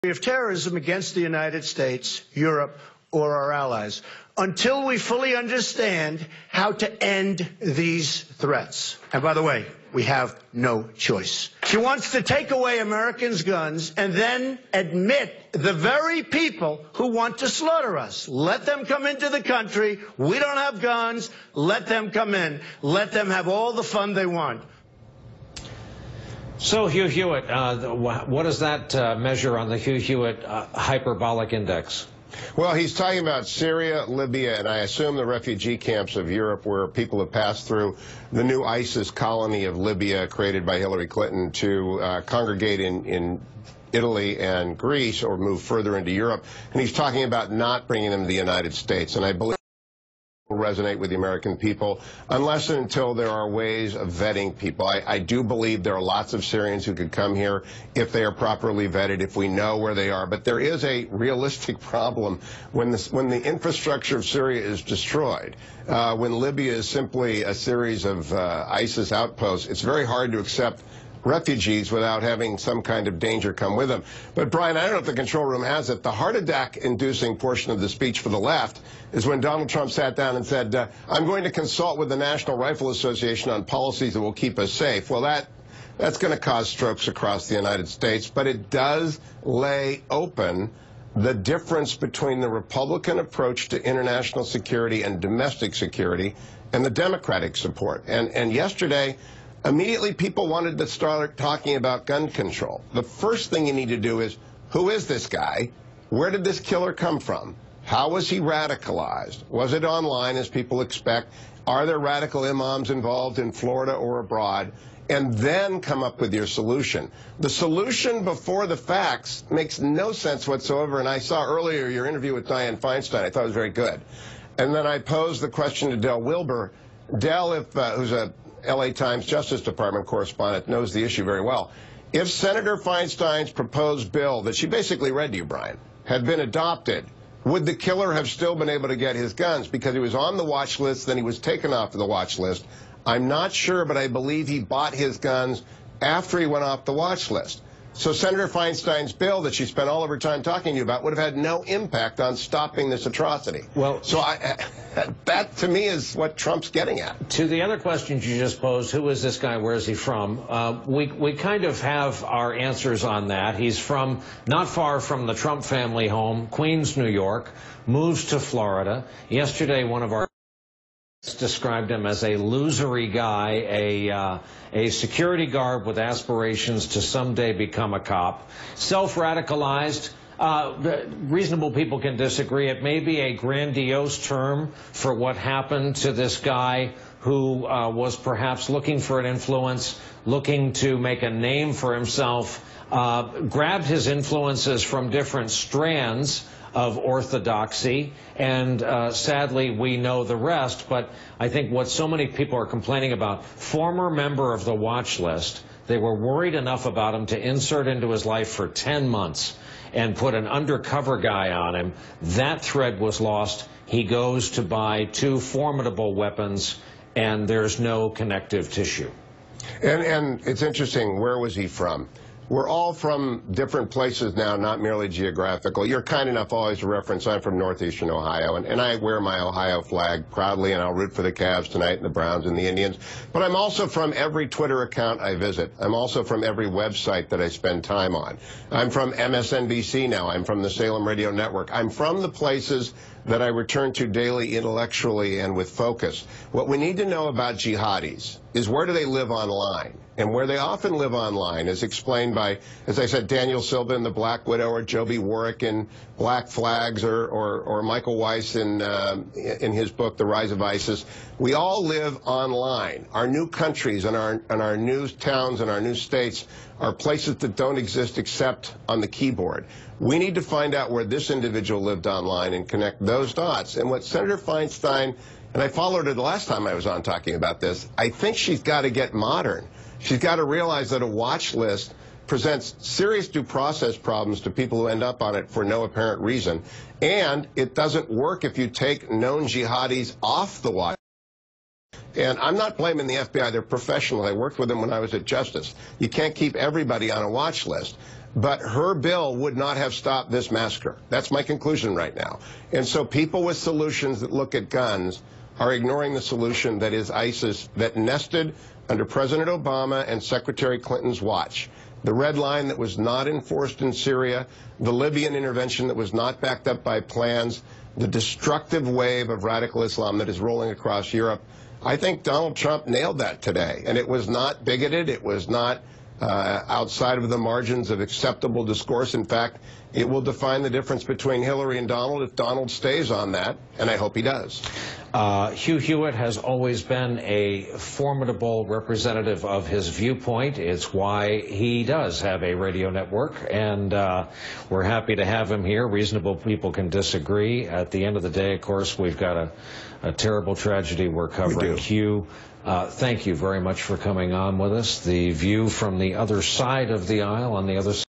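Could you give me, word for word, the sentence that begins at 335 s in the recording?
Uh, Hugh Hewitt has always been a formidable representative of his viewpoint.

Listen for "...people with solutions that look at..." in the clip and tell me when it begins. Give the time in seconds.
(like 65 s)
303 s.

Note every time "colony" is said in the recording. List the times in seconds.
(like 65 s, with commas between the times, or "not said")
39 s.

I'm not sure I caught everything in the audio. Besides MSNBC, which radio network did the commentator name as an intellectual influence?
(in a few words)
Salem Radio Network.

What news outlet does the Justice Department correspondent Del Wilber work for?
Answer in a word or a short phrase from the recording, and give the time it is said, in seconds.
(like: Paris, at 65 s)
LA Times, at 128 s.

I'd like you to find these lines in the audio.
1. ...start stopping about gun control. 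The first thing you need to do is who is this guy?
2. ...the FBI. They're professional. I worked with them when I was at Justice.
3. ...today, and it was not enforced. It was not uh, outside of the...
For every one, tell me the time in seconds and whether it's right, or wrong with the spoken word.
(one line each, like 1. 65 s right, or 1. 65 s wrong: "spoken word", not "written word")
1. 100 s wrong: "talking", not "stopping"
2. 293 s right
3. 323 s wrong: "bigoted", not "enforced".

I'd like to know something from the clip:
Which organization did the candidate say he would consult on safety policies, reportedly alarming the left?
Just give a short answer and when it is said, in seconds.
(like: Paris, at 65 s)
National Rifle Association, at 82 s.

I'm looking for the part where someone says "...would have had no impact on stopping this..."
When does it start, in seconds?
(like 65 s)
151 s.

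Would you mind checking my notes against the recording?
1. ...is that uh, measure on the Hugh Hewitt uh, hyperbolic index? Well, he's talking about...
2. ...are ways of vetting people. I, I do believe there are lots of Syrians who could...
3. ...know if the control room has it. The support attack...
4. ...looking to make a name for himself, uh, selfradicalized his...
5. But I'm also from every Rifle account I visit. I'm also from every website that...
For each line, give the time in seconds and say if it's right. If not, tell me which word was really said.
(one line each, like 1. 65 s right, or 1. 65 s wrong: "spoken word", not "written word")
1. 28 s right
2. 53 s right
3. 74 s wrong: "heart", not "support"
4. 190 s wrong: "grabbed", not "selfradicalized"
5. 233 s wrong: "Twitter", not "Rifle".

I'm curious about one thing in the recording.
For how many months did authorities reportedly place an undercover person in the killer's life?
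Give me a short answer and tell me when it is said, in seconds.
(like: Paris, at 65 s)
10, at 208 s.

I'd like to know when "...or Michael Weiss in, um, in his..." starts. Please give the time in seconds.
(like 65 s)
257 s.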